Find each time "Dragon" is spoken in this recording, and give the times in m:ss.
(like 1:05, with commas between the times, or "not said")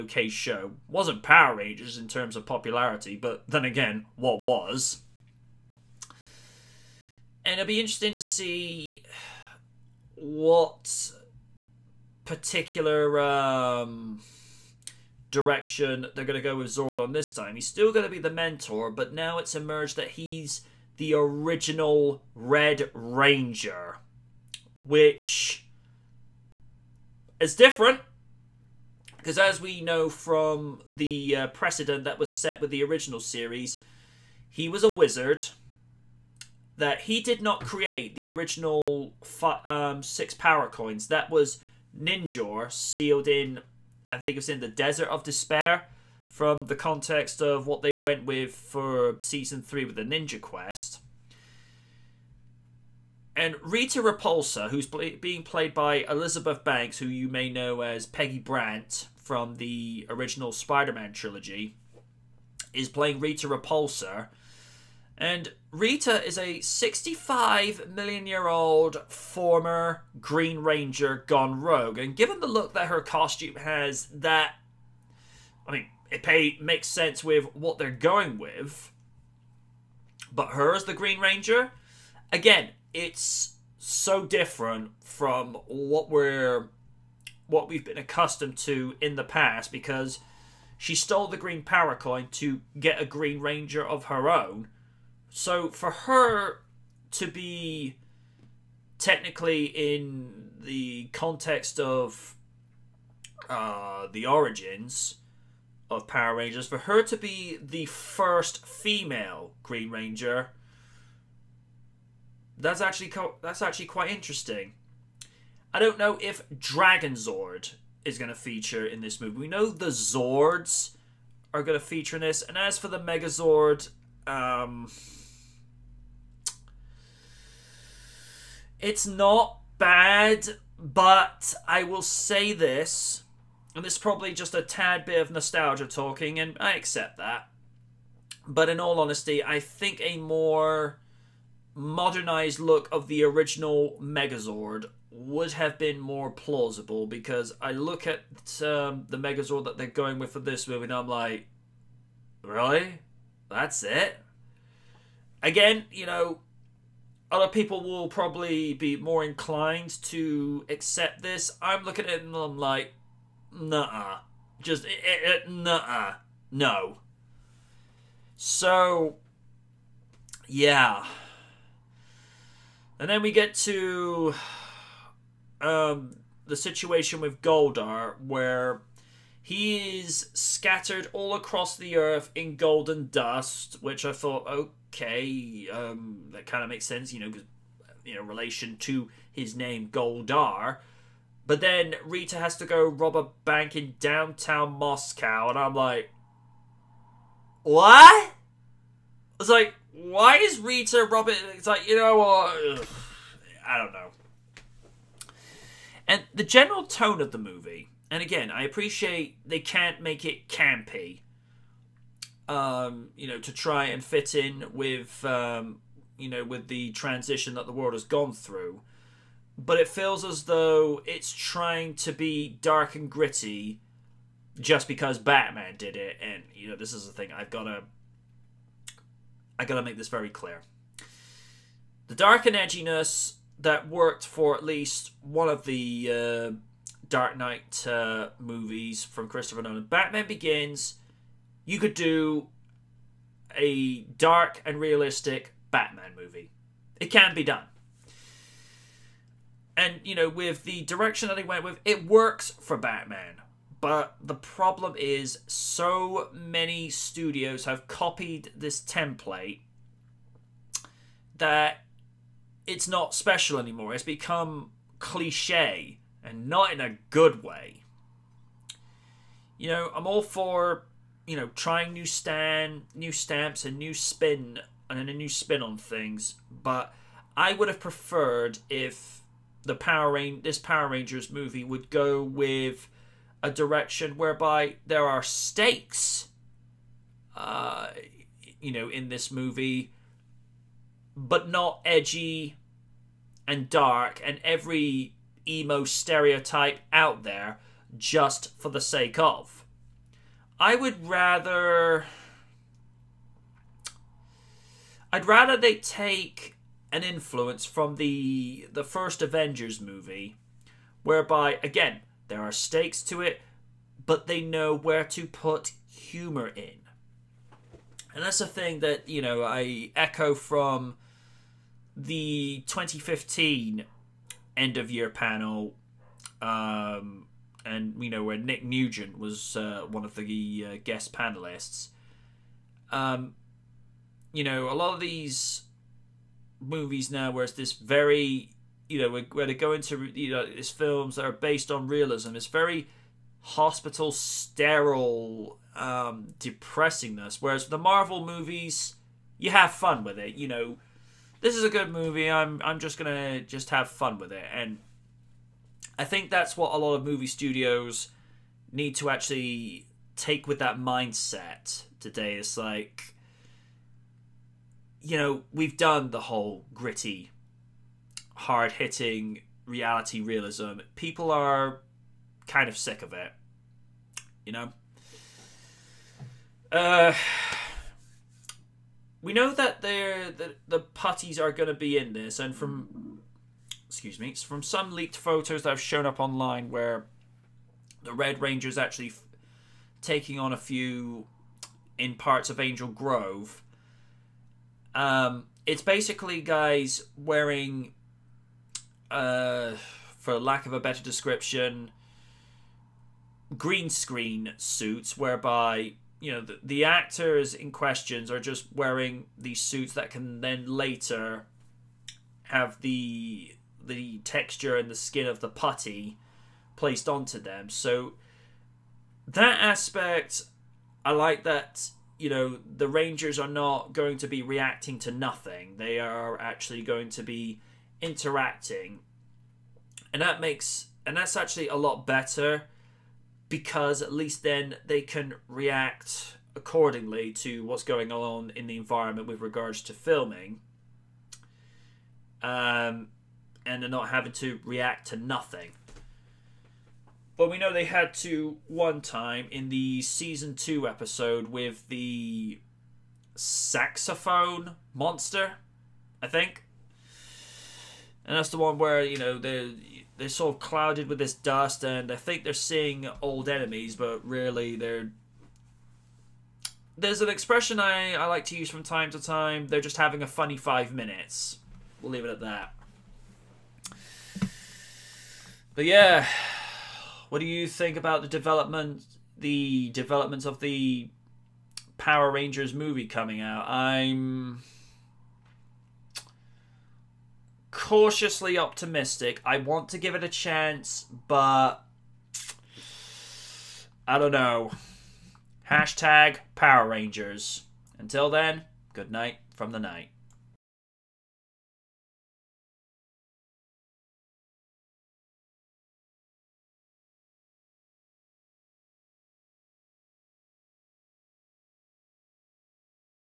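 1:56.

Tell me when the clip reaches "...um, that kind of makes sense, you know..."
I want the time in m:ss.
3:05.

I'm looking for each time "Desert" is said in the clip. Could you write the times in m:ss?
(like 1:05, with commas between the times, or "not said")
0:44.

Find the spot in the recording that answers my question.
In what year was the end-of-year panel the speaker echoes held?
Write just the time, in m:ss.
5:22.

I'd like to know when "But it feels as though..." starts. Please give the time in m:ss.
3:39.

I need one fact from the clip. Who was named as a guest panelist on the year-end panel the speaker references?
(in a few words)
Nick Nugent.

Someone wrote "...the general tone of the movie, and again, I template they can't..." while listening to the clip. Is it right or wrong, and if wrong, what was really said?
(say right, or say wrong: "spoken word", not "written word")
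wrong: "appreciate", not "template".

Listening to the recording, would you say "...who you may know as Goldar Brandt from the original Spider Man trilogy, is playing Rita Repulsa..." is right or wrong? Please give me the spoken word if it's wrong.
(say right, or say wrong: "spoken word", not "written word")
wrong: "Peggy", not "Goldar".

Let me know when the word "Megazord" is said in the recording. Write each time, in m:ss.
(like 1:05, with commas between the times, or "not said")
2:02, 2:24, 2:29.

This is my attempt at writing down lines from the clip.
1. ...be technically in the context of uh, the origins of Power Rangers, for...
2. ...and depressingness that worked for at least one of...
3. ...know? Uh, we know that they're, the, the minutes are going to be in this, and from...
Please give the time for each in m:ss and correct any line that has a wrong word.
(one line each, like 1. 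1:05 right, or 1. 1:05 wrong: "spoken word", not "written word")
1. 1:37 right
2. 3:52 wrong: "edginess", not "depressingness"
3. 6:14 wrong: "putties", not "minutes".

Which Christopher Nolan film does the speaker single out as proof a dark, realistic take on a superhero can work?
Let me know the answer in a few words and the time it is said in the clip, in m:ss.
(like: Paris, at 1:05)
Batman Begins, at 3:59.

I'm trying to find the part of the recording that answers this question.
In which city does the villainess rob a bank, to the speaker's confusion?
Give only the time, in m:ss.
3:14.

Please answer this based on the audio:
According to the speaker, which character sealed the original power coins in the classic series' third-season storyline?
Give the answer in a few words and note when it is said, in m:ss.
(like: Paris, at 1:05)
Ninjor, at 0:41.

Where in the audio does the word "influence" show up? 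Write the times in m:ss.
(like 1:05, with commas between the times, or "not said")
5:07.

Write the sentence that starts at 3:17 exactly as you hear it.
I was like, why is Rita robbing?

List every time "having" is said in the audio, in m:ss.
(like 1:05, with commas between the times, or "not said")
7:24, 7:49.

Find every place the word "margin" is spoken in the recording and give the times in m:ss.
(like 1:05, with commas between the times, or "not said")
not said.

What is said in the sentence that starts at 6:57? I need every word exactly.
So that aspect, I like that.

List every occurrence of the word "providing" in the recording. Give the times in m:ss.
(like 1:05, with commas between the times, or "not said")
not said.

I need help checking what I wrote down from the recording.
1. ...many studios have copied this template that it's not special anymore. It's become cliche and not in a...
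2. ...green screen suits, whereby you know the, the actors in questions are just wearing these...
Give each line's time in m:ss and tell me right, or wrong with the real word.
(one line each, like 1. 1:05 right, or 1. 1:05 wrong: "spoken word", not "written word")
1. 4:16 right
2. 6:43 right.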